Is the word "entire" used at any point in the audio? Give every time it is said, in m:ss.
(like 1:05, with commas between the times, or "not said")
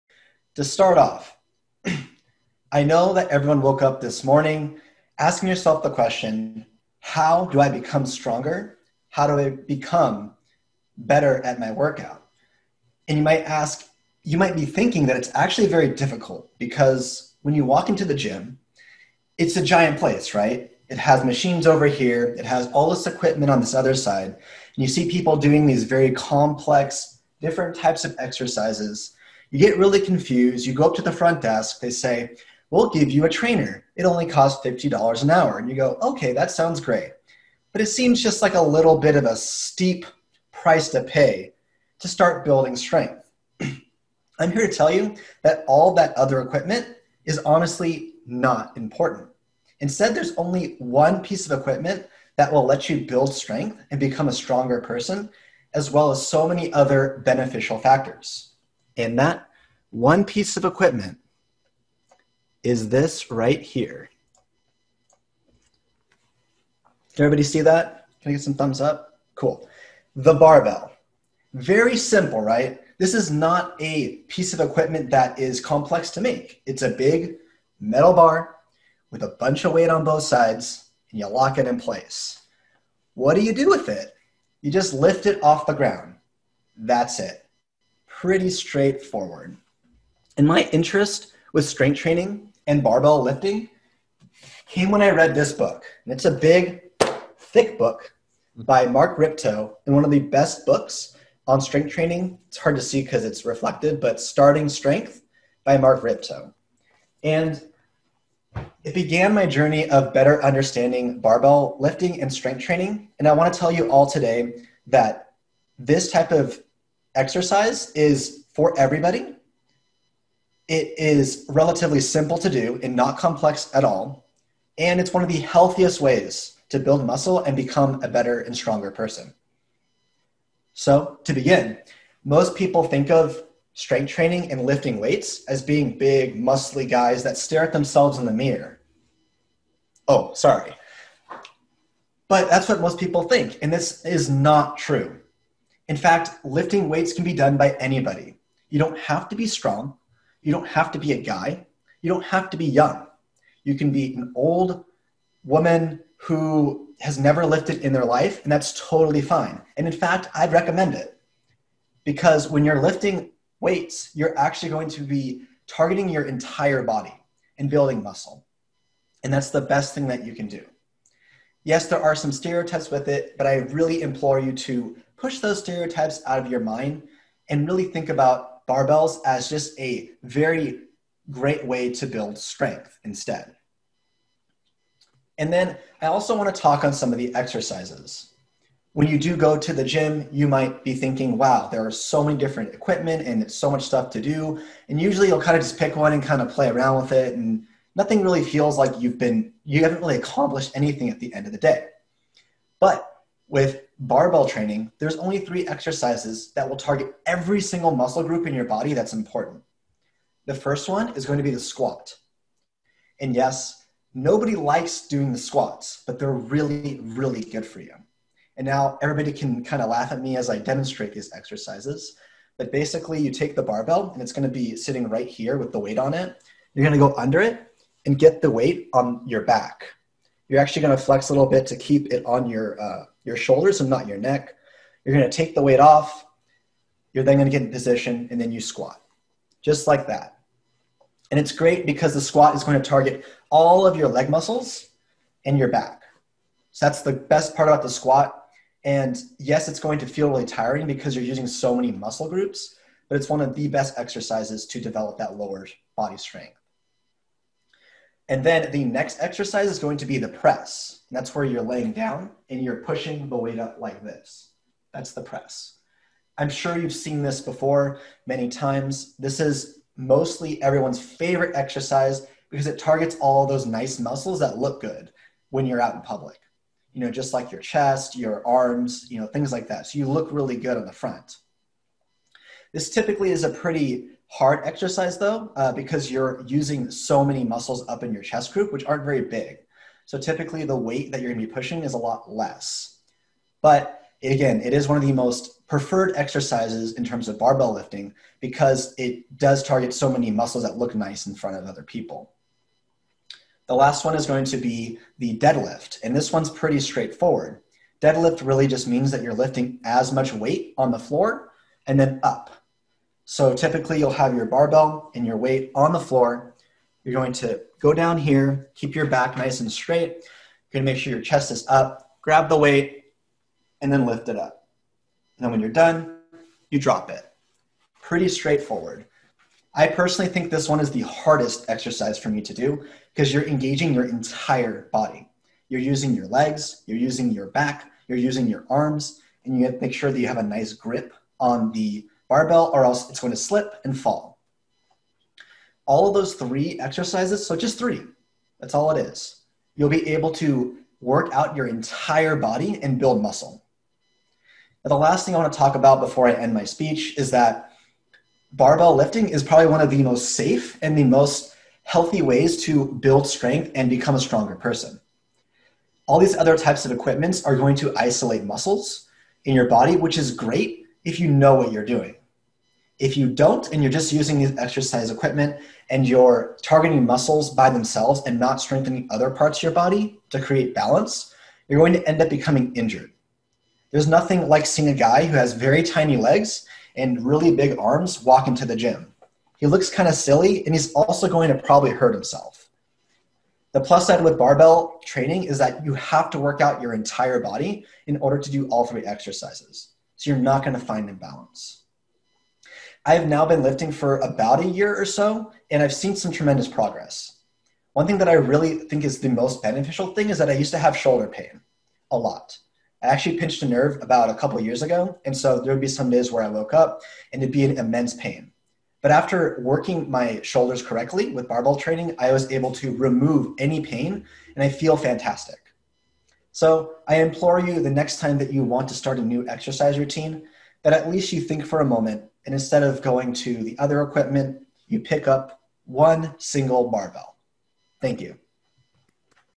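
2:46, 5:34, 5:51, 6:36.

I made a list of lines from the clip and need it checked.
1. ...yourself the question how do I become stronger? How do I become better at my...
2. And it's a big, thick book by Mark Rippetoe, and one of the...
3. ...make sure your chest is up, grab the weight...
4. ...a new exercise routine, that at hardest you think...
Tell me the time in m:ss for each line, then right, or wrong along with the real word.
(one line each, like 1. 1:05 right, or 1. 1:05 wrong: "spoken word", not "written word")
1. 0:05 right
2. 1:36 right
3. 5:20 right
4. 7:09 wrong: "least", not "hardest".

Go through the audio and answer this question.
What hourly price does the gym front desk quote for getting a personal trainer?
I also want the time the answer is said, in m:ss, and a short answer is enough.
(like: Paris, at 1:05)
$50, at 0:34.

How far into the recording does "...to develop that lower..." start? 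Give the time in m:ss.
4:14.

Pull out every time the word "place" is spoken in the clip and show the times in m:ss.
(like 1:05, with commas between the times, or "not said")
0:19, 1:21.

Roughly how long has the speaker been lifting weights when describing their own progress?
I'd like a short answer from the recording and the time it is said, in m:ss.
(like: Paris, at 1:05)
About a year, at 6:44.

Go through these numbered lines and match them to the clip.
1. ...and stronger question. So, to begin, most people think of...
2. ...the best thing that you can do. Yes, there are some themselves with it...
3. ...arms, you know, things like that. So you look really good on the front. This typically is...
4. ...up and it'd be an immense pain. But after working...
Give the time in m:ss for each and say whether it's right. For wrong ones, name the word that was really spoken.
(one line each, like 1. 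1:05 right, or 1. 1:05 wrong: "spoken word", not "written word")
1. 2:08 wrong: "person", not "question"
2. 2:49 wrong: "stereotypes", not "themselves"
3. 4:38 right
4. 6:56 right.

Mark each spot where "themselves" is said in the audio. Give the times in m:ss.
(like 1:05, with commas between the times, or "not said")
2:17, 6:17.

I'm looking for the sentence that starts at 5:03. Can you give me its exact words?
The last one is going to be the deadlift, and this one's pretty straightforward.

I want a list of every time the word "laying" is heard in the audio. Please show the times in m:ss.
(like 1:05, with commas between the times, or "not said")
4:21.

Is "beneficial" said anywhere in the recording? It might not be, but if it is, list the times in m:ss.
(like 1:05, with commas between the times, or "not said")
0:57, 6:49.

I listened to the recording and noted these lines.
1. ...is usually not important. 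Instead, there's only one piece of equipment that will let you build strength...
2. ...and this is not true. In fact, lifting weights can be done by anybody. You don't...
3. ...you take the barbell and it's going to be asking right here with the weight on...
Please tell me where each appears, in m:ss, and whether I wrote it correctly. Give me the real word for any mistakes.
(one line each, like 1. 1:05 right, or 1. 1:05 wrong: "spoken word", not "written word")
1. 0:47 wrong: "honestly", not "usually"
2. 2:23 right
3. 3:43 wrong: "sitting", not "asking".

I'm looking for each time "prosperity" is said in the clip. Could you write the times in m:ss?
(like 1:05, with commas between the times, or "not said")
not said.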